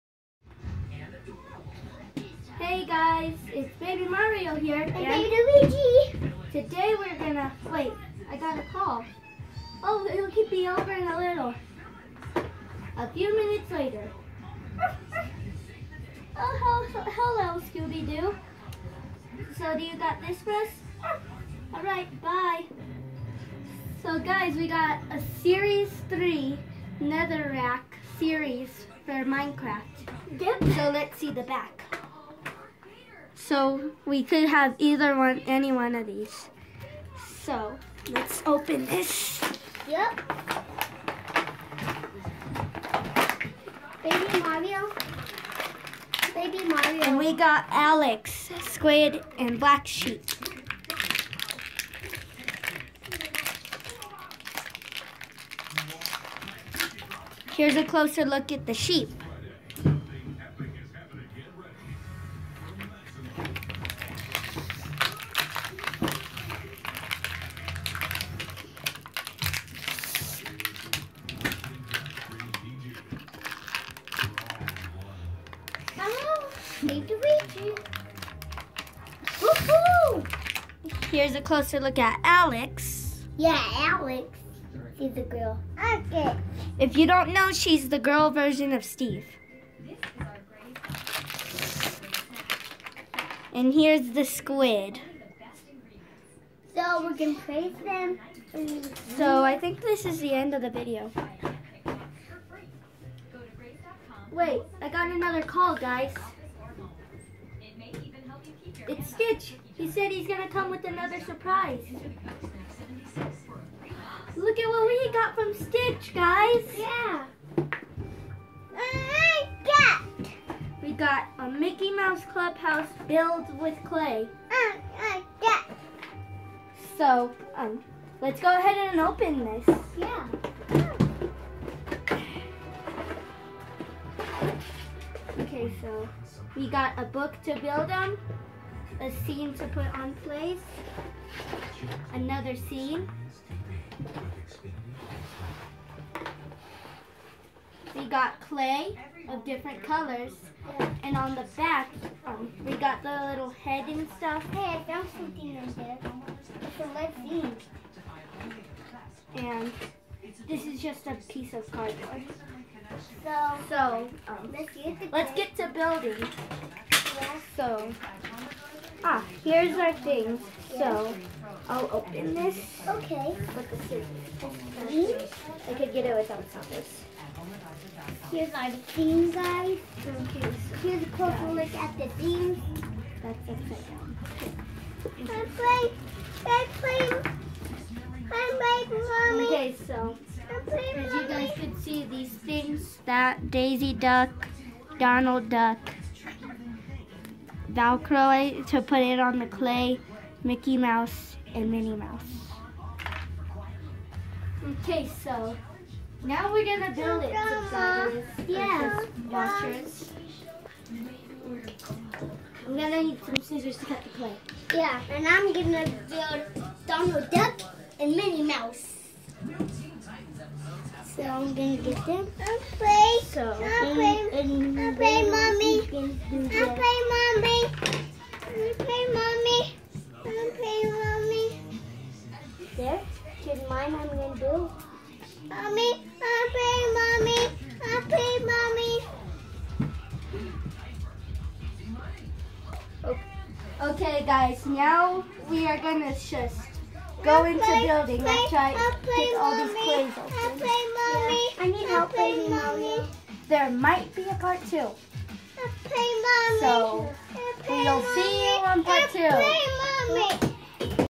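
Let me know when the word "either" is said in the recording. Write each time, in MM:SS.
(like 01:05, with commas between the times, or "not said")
00:34.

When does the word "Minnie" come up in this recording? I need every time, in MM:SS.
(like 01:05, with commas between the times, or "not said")
03:21, 03:38.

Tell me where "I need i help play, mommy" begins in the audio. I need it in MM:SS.
04:11.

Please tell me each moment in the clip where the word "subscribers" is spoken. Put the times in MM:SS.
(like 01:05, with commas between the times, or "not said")
03:27.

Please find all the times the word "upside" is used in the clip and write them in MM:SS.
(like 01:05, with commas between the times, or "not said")
03:03.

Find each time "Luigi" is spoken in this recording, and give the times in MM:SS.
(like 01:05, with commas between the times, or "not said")
00:05, 01:17.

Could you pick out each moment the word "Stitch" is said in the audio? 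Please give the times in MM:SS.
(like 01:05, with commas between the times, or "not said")
01:49, 01:55.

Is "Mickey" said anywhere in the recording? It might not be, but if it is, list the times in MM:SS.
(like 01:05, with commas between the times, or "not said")
02:01, 03:20.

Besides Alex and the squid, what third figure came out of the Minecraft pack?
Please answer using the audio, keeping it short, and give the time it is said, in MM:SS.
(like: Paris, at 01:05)
Black Sheep, at 00:49.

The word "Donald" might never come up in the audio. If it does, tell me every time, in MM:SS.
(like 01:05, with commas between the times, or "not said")
03:14, 03:36.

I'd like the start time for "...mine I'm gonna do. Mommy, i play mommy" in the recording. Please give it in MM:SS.
03:53.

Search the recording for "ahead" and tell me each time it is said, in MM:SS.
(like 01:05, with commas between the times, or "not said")
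02:08.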